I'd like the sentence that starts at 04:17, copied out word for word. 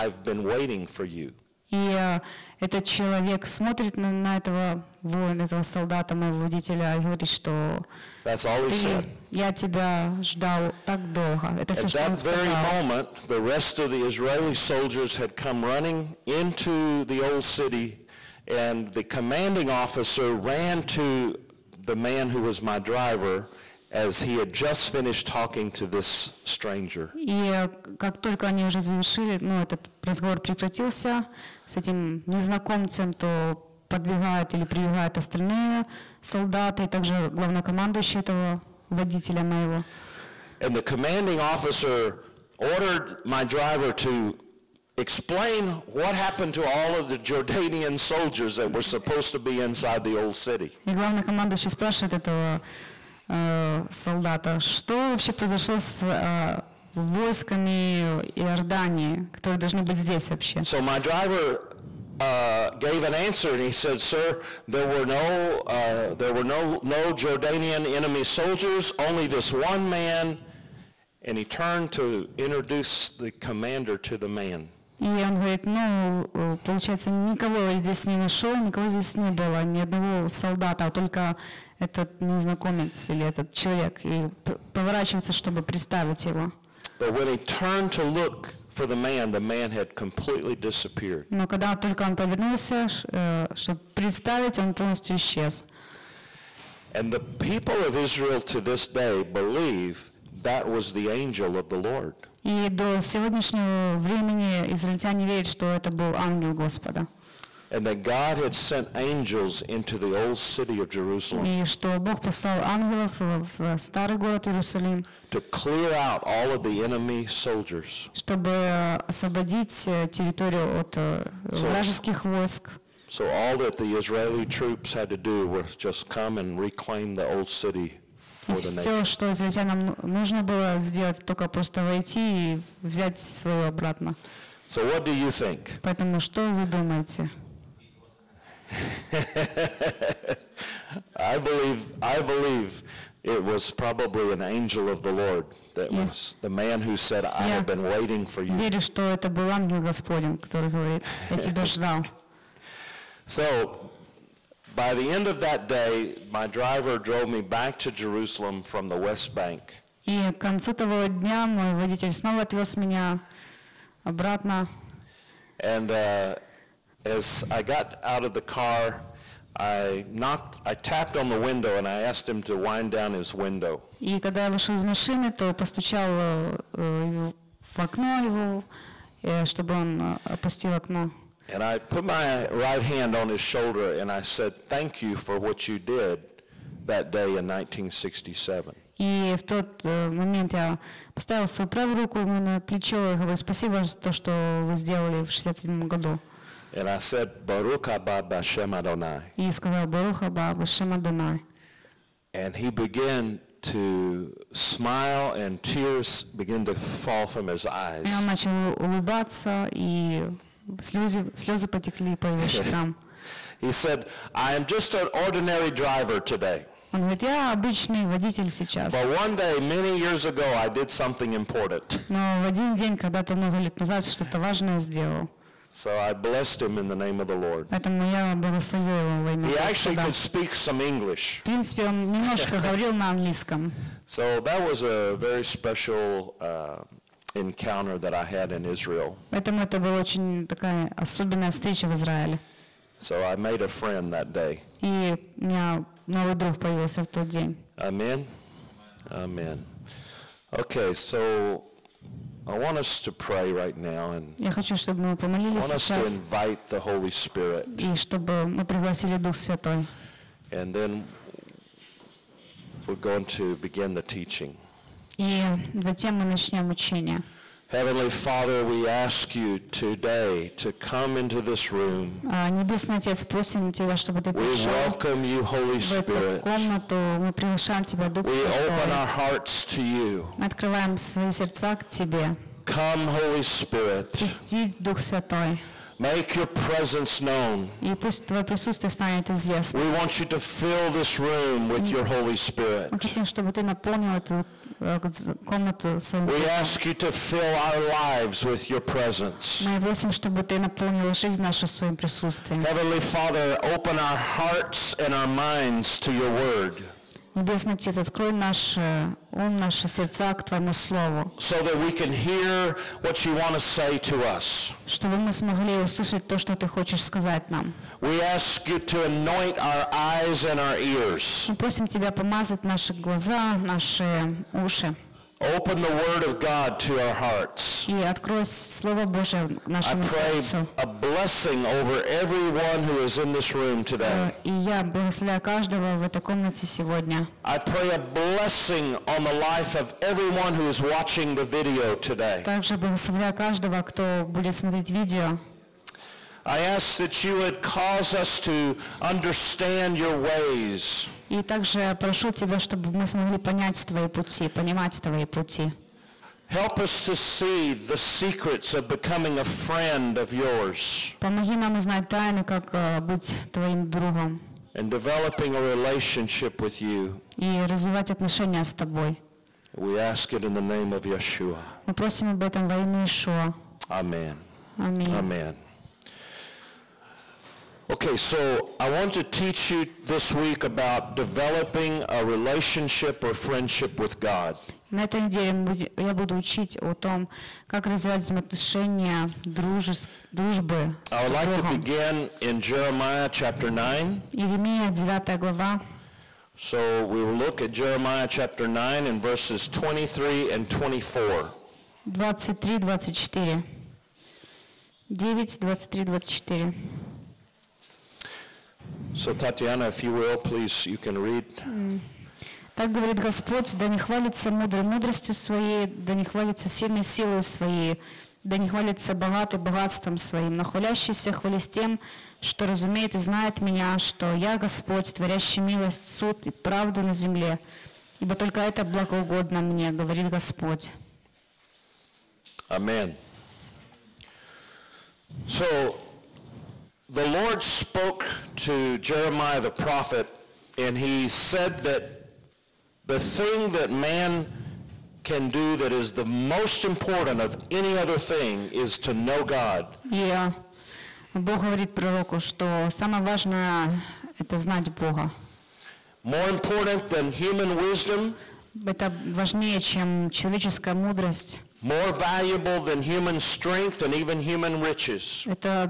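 И чтобы мы пригласили Дух Святой.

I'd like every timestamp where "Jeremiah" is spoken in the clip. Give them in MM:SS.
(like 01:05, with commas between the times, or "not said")
06:32, 06:37, 07:18.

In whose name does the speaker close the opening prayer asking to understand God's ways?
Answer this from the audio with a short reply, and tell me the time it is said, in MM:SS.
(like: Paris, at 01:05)
Yeshua, at 06:11.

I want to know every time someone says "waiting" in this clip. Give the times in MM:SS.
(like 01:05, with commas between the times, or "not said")
00:00, 02:27.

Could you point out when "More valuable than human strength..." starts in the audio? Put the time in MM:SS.
07:41.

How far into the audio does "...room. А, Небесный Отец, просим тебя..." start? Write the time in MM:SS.
04:31.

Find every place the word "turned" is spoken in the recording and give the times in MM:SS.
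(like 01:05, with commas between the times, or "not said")
01:11, 01:27.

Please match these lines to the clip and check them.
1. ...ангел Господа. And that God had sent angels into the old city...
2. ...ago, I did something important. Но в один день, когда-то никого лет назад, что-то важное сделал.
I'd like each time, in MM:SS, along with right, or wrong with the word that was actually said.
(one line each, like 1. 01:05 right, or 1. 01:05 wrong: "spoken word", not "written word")
1. 01:46 right
2. 03:40 wrong: "много", not "никого".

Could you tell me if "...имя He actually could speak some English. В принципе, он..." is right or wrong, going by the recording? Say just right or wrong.
right.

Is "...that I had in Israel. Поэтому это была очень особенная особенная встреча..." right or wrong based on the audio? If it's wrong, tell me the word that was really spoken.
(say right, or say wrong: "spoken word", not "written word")
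wrong: "такая", not "особенная".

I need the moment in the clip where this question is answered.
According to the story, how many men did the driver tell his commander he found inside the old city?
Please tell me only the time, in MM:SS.
01:08.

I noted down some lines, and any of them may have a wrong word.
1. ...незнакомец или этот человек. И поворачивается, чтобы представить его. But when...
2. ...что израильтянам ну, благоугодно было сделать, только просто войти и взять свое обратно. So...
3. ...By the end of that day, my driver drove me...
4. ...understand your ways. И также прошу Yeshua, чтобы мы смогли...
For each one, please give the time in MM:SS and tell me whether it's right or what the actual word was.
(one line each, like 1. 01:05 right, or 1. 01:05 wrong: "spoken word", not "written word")
1. 01:22 right
2. 02:09 wrong: "нужно", not "благоугодно"
3. 02:34 right
4. 05:49 wrong: "Тебя", not "Yeshua".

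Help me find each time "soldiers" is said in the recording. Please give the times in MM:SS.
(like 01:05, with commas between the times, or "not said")
00:14, 00:47, 01:08, 01:57.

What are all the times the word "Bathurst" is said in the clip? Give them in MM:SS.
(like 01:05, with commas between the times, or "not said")
not said.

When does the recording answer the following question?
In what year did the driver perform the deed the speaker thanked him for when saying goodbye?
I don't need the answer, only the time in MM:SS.
03:07.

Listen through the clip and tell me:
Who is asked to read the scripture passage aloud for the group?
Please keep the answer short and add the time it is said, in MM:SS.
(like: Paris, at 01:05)
Tatiana, at 06:49.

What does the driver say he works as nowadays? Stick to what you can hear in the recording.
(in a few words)
Ordinary driver.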